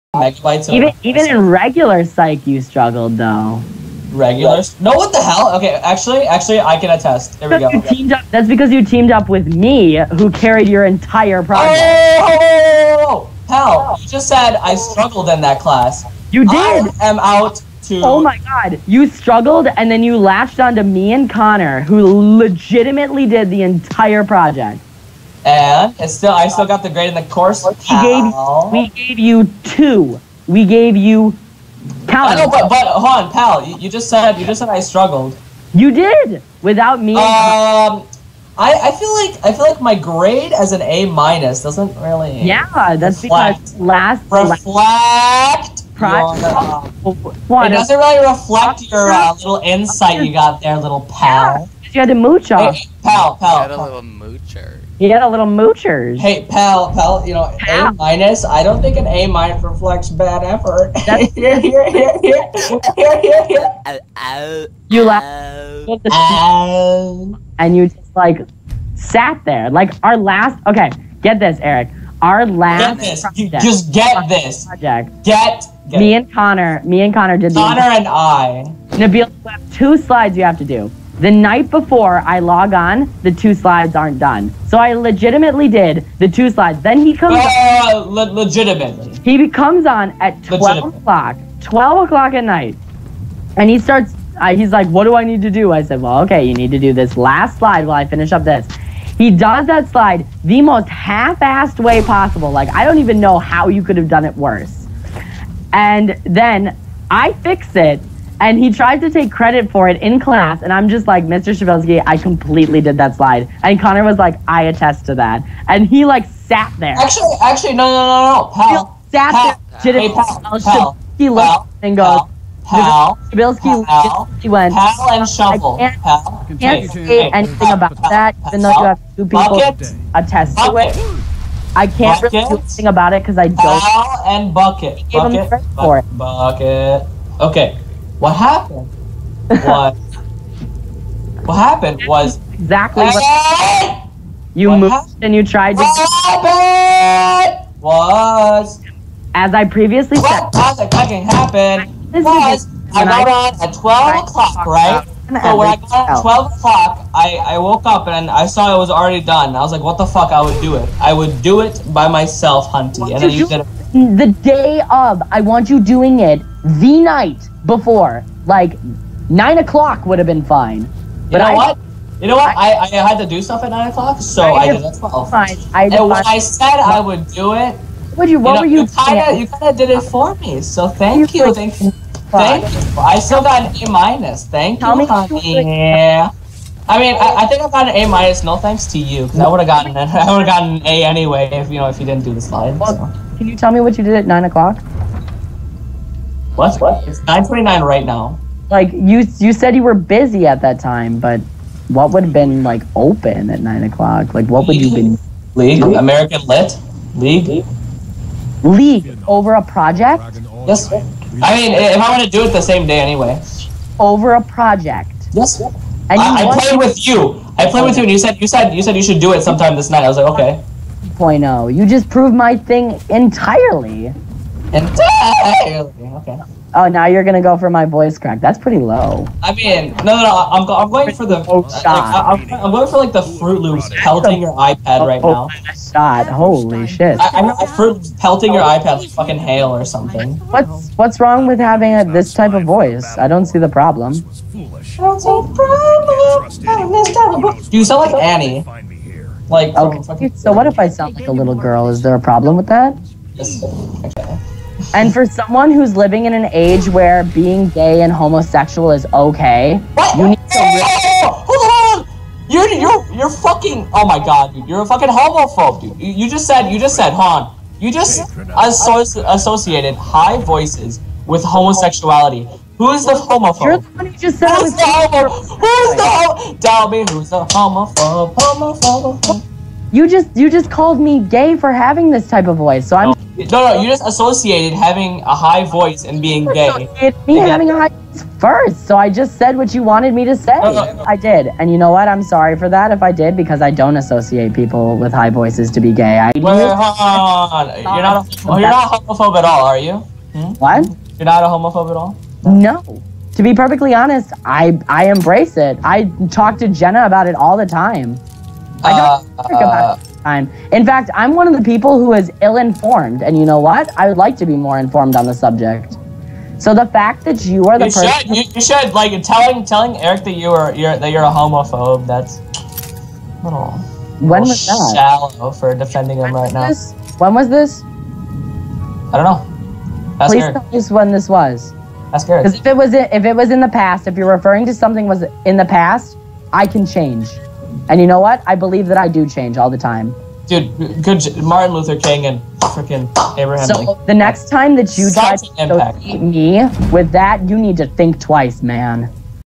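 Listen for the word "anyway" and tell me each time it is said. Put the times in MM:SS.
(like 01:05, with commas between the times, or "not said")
03:11, 03:32.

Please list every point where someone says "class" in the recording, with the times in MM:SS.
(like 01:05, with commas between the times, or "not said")
00:15, 01:50.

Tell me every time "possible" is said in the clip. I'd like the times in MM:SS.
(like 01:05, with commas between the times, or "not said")
01:42.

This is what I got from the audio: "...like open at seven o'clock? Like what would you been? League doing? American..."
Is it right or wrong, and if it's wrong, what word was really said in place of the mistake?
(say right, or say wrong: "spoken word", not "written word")
wrong: "nine", not "seven".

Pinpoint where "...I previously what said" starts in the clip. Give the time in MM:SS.
02:29.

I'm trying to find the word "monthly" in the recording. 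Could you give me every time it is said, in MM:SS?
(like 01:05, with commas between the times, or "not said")
not said.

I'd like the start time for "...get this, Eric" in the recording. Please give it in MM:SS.
01:11.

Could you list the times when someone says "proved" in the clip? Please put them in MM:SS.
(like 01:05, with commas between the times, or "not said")
03:42.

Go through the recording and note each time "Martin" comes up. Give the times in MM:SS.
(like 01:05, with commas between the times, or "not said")
05:41.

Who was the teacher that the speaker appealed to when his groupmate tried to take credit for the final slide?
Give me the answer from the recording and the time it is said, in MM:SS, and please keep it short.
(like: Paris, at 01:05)
Mr. Shabelsky, at 01:51.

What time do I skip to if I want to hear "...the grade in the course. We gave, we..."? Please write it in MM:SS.
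00:26.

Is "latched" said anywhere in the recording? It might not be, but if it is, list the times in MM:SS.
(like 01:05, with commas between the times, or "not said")
00:20.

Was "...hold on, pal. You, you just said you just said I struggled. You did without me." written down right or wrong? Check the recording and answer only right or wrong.
right.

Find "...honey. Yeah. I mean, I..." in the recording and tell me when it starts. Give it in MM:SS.
03:05.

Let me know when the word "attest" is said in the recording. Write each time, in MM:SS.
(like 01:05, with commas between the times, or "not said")
00:06, 01:54, 02:10.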